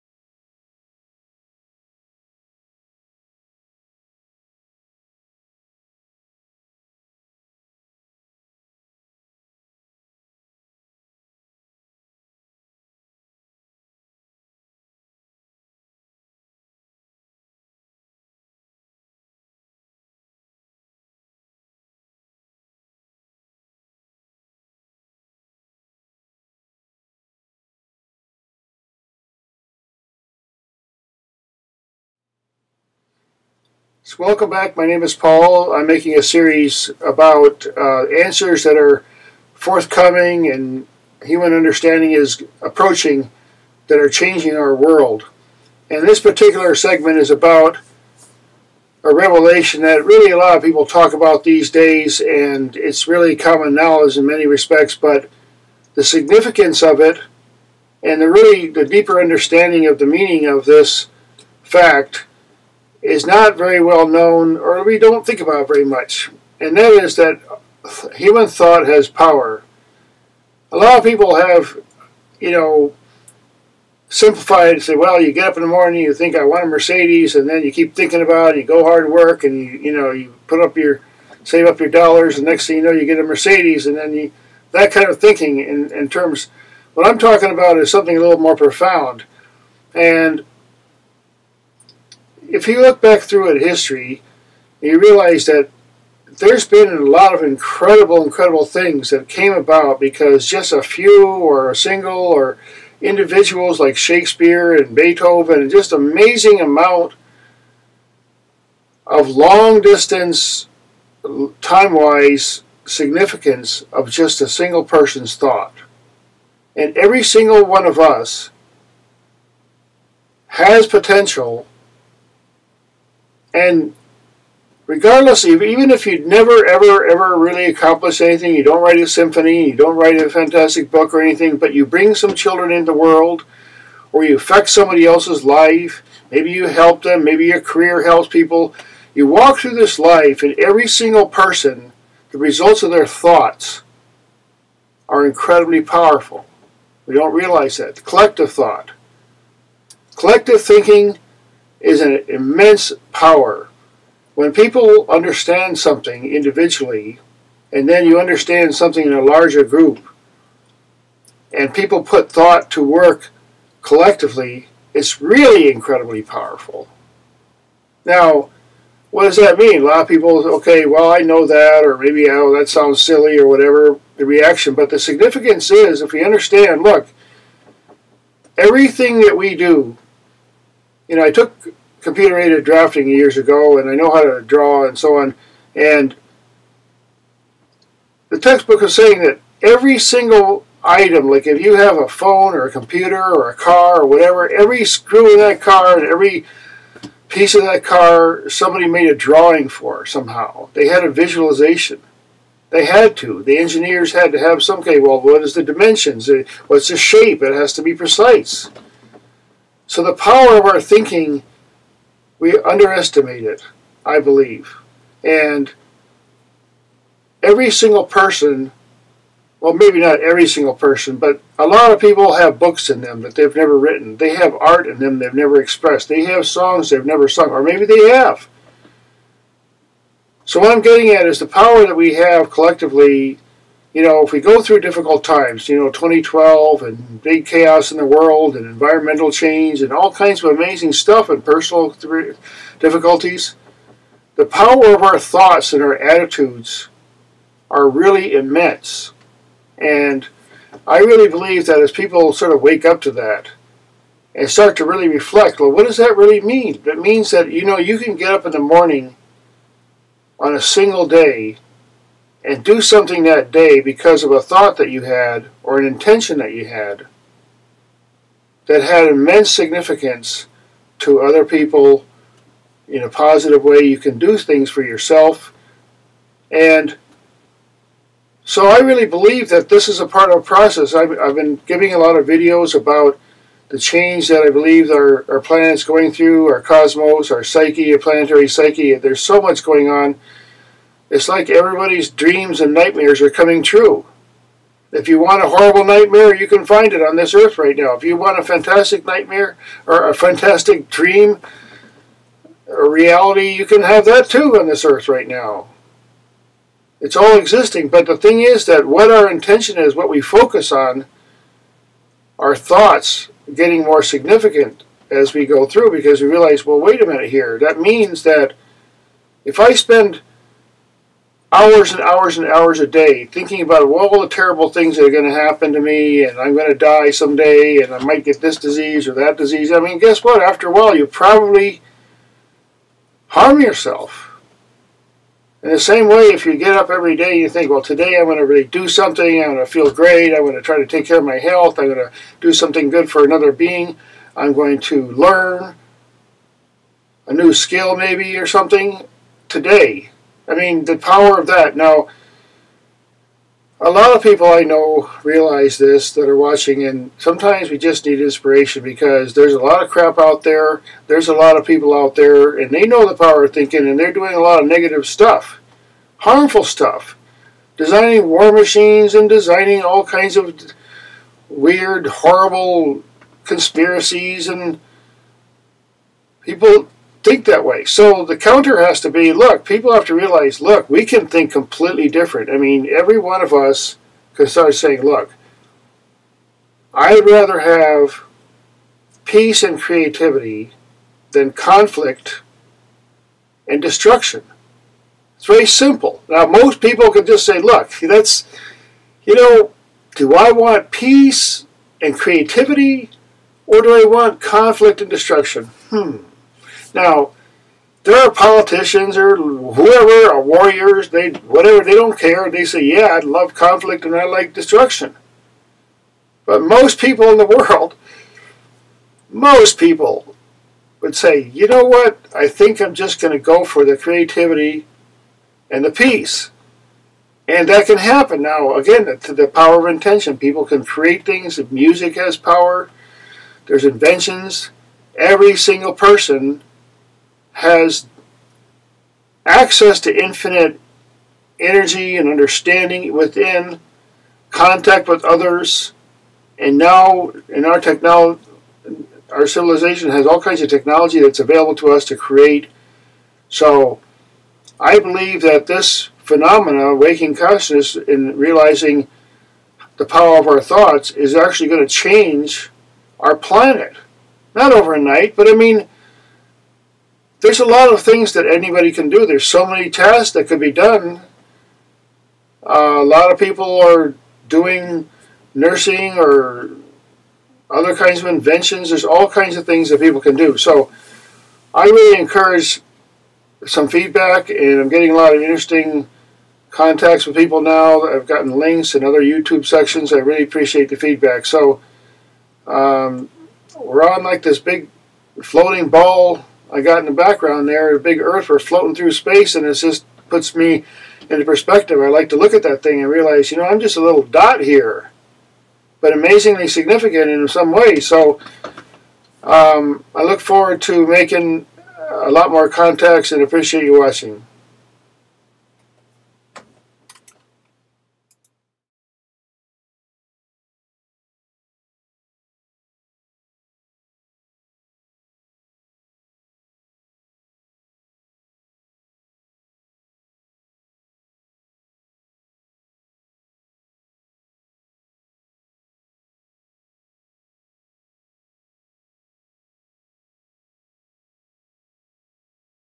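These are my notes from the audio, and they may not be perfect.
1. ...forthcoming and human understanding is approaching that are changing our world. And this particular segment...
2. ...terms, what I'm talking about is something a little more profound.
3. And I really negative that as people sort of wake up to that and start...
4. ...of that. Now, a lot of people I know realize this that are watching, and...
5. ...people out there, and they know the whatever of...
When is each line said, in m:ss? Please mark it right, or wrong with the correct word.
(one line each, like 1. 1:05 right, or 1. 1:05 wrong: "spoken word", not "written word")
1. 0:39 right
2. 1:26 right
3. 4:09 wrong: "believe", not "negative"
4. 5:51 right
5. 6:01 wrong: "power", not "whatever".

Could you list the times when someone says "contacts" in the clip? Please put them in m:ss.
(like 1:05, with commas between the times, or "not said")
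7:24, 8:06, 8:32.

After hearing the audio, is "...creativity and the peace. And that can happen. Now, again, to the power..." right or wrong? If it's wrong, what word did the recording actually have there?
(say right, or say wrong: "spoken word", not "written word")
right.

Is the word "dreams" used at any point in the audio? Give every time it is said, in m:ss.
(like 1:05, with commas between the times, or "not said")
4:52, 5:00.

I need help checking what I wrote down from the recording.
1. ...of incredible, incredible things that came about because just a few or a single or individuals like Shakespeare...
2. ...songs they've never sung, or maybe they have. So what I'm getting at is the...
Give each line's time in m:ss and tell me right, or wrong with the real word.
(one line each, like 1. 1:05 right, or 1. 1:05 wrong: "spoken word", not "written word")
1. 1:37 right
2. 3:46 right.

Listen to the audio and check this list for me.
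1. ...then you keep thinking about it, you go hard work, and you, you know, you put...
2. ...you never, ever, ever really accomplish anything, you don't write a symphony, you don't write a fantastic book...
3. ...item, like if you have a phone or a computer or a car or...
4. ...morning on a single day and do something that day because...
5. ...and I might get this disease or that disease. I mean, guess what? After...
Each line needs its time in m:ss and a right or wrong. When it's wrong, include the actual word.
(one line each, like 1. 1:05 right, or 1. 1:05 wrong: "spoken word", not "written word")
1. 1:17 right
2. 2:06 right
3. 3:10 right
4. 4:18 right
5. 5:27 right.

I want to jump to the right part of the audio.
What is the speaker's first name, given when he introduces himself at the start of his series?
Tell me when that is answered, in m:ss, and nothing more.
0:35.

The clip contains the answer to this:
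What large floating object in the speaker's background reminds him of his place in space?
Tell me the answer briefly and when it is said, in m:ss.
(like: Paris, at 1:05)
a big Earth, at 8:17.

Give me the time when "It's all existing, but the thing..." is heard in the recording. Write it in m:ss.
5:07.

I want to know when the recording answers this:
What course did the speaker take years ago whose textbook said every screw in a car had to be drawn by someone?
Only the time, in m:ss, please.
3:01.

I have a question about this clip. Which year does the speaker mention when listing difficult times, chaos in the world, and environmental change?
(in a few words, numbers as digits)
2012.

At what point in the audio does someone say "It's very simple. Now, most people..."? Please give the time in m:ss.
6:35.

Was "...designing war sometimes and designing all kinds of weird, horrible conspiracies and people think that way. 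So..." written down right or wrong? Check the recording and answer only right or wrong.
wrong.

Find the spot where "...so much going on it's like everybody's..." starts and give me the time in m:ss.
4:49.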